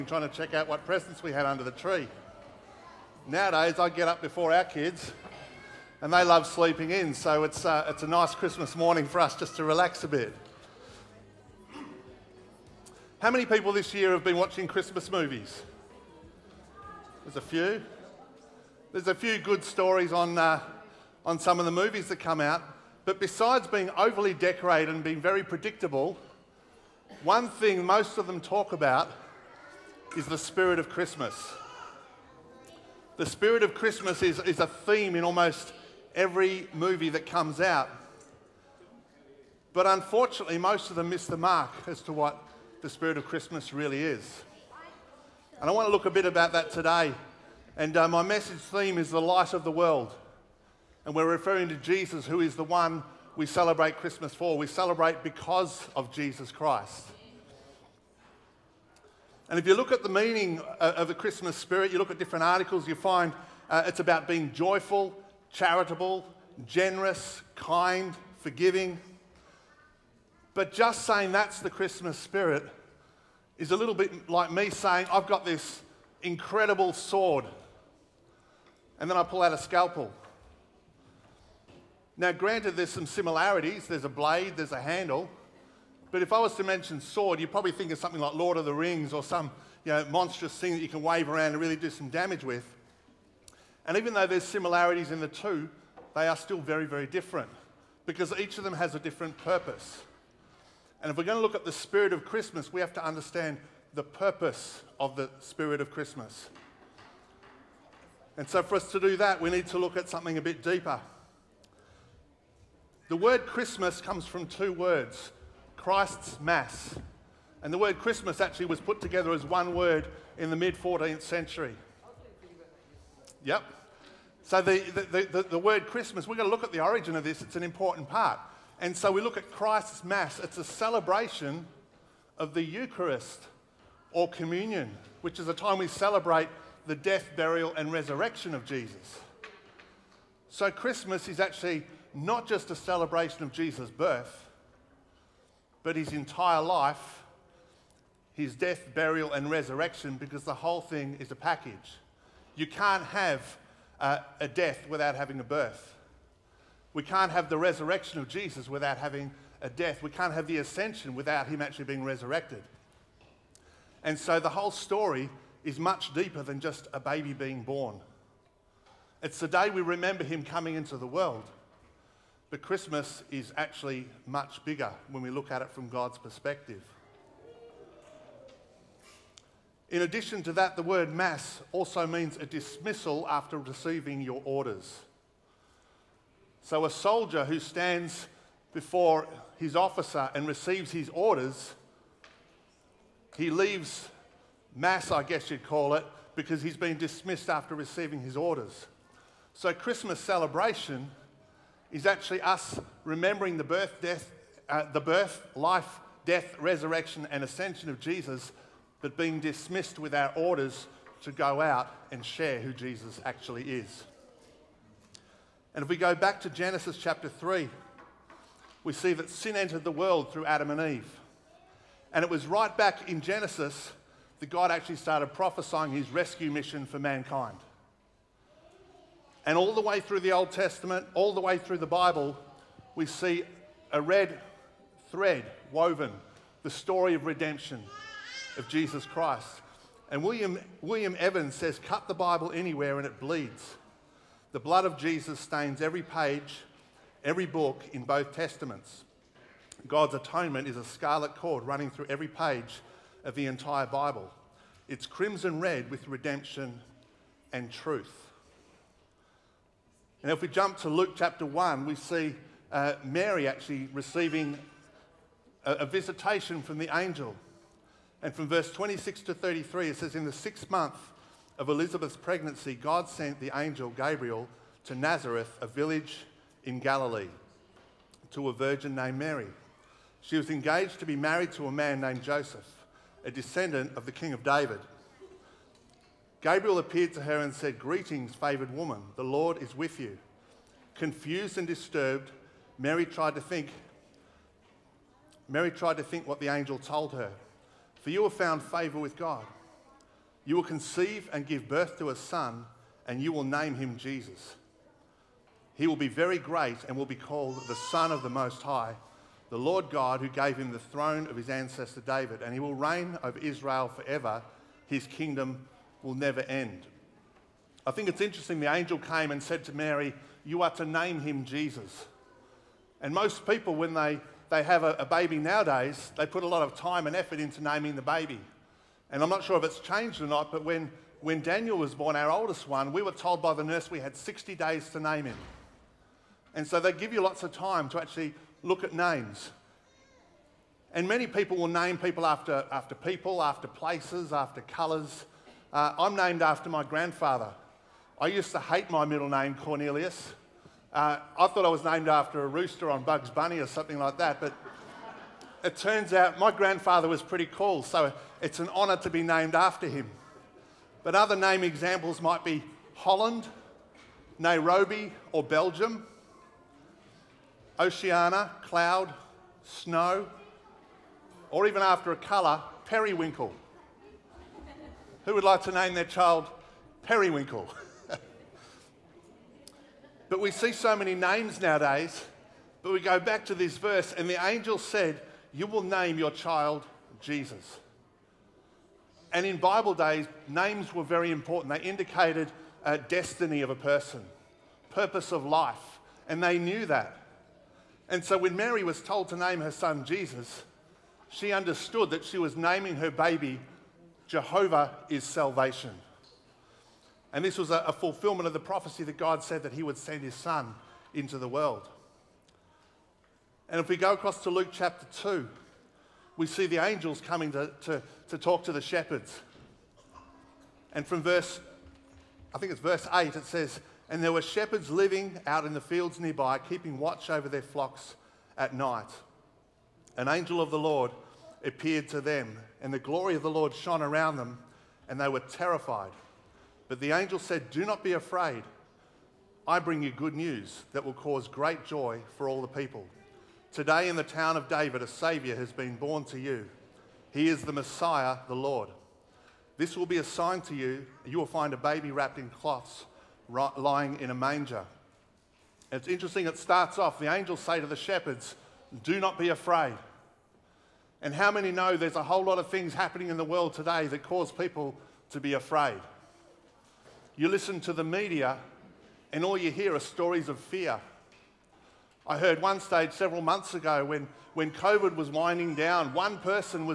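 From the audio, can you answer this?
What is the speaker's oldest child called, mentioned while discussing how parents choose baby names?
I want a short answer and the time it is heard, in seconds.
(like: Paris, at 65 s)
Daniel, at 331 s.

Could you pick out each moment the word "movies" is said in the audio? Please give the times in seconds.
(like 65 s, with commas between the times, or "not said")
15 s, 21 s, 36 s.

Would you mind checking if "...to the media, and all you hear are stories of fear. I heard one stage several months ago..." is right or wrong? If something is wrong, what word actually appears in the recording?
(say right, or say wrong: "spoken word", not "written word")
right.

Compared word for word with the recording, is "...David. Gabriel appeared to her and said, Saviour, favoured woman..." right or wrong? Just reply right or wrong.
wrong.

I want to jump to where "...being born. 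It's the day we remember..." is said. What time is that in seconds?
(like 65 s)
167 s.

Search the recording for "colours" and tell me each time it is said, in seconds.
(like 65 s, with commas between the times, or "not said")
344 s, 372 s.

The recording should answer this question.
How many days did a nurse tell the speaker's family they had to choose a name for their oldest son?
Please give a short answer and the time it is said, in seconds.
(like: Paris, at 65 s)
60, at 334 s.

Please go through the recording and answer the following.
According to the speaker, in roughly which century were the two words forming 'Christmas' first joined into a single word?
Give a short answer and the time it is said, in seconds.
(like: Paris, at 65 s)
mid 14th century, at 120 s.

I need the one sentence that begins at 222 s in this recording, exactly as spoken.
And it was right back in Genesis that God actually started prophesying his rescue mission for mankind.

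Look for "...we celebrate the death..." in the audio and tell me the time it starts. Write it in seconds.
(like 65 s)
135 s.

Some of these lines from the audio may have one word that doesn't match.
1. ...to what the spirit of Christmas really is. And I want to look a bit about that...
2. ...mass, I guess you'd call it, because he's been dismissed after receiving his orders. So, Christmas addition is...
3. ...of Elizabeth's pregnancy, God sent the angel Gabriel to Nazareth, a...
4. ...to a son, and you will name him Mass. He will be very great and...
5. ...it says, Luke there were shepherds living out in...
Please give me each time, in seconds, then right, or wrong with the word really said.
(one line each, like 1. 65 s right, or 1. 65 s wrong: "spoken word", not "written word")
1. 42 s right
2. 194 s wrong: "celebration", not "addition"
3. 271 s right
4. 301 s wrong: "Jesus", not "Mass"
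5. 423 s wrong: "And", not "Luke".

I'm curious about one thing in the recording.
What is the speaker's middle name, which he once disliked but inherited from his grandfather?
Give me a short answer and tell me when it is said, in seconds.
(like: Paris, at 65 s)
Cornelius, at 349 s.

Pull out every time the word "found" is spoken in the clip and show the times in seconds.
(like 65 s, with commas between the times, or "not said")
298 s.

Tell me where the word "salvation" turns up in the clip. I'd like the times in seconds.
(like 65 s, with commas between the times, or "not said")
405 s.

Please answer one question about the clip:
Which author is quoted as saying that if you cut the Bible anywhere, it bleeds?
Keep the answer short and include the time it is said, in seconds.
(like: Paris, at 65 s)
William Evans, at 240 s.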